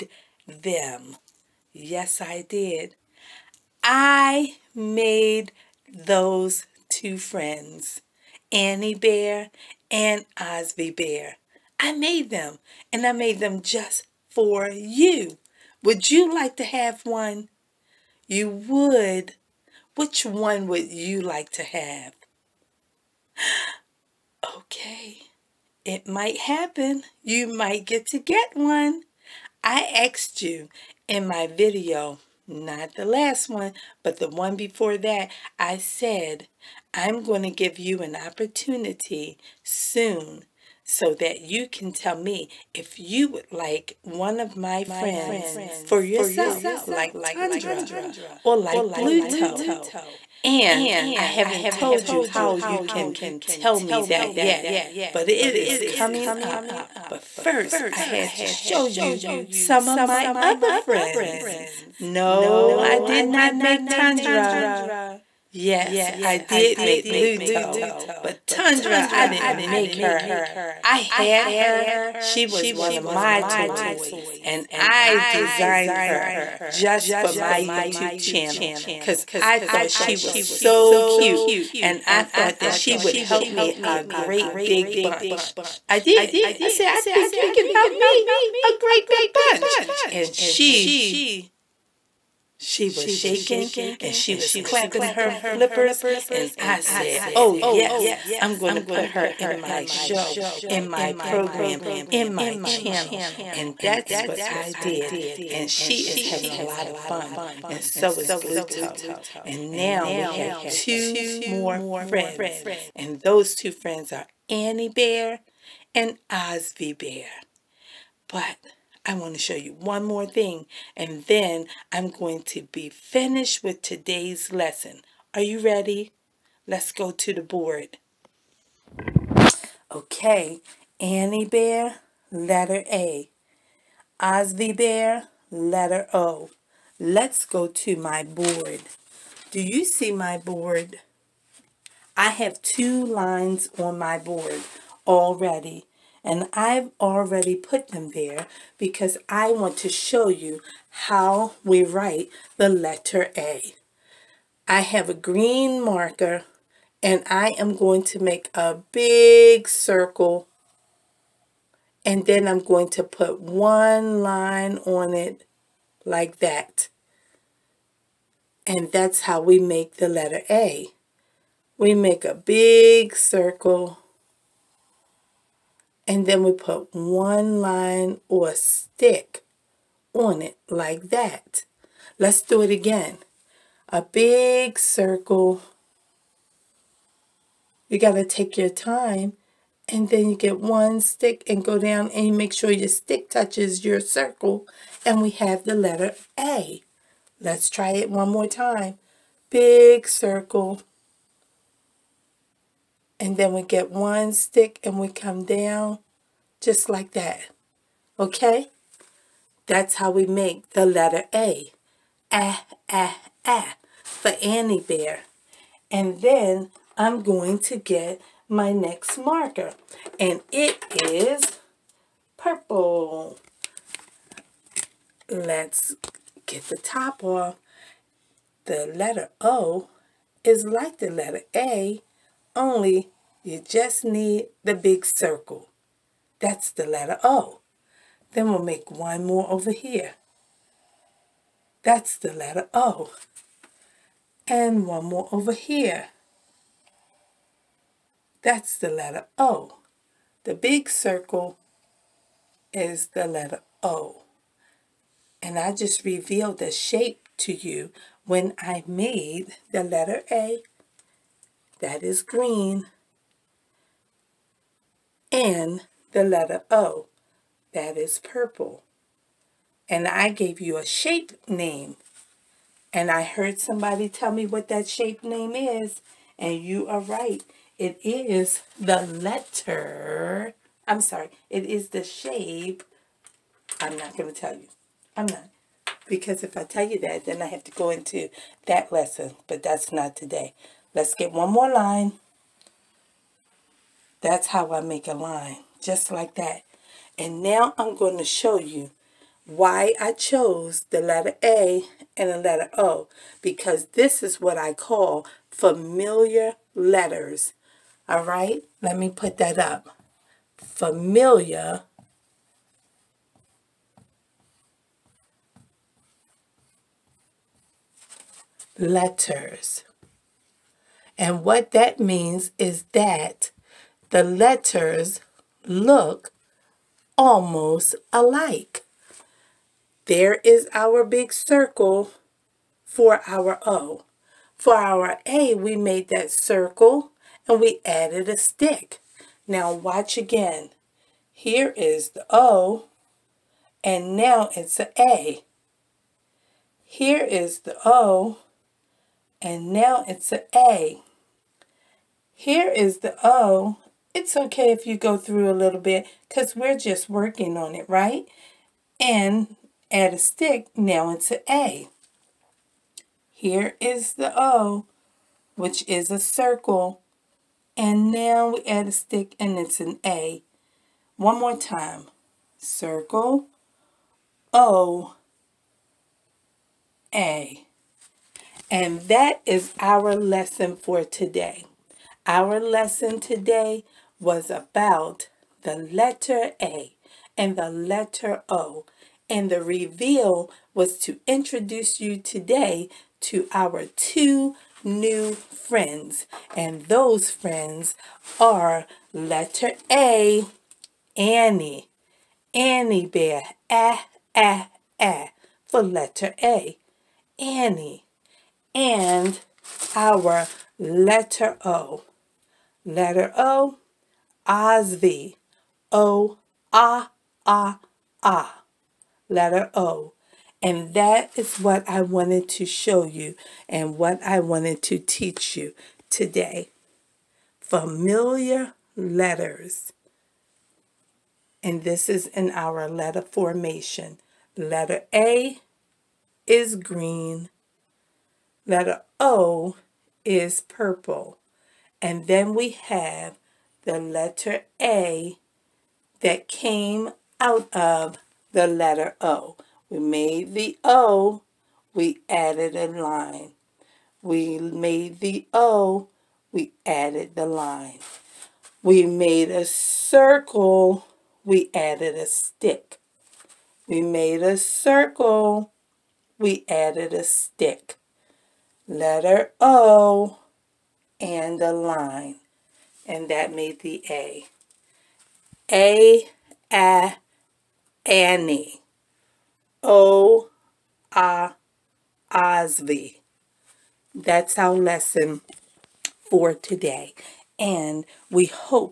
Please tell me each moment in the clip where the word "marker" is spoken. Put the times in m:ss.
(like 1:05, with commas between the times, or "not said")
2:35, 3:39.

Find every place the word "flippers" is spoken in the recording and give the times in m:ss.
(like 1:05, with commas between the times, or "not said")
1:35.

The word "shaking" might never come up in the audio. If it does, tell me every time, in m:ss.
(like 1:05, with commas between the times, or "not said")
1:33.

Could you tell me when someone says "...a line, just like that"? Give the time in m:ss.
4:55.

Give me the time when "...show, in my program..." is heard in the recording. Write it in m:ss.
1:39.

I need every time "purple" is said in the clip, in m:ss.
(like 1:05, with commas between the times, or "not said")
3:42, 4:28, 7:20.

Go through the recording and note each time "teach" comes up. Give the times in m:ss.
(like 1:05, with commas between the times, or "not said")
7:04.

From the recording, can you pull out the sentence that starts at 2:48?
And that's how we make the letter A.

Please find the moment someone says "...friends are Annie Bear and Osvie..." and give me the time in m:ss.
1:53.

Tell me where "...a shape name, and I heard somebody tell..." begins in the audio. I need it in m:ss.
4:30.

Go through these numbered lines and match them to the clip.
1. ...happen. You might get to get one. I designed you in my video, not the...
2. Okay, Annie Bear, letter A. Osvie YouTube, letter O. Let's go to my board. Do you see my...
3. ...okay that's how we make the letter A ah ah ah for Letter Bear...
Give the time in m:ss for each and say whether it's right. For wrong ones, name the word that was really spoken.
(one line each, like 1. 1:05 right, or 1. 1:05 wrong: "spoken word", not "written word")
1. 0:26 wrong: "asked", not "designed"
2. 2:09 wrong: "Bear", not "YouTube"
3. 3:28 wrong: "Annie", not "Letter".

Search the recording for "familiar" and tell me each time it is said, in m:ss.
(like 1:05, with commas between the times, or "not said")
5:05, 5:10, 7:07.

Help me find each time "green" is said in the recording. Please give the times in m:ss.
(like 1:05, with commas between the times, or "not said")
2:35, 4:22, 7:16.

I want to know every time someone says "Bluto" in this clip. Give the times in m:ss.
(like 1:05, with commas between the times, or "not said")
1:07, 1:48.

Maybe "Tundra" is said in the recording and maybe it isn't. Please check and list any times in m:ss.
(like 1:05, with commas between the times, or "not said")
0:47, 1:03, 1:08.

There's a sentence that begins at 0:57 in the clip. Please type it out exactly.
But first, I had to show you some of my other friends.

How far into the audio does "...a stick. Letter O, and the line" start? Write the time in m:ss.
7:47.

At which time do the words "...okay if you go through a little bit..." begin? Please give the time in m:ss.
5:54.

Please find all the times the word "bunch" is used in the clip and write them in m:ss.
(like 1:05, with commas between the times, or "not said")
1:25, 1:29.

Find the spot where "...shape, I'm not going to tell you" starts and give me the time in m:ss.
4:42.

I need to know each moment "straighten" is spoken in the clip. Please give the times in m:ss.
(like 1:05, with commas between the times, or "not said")
not said.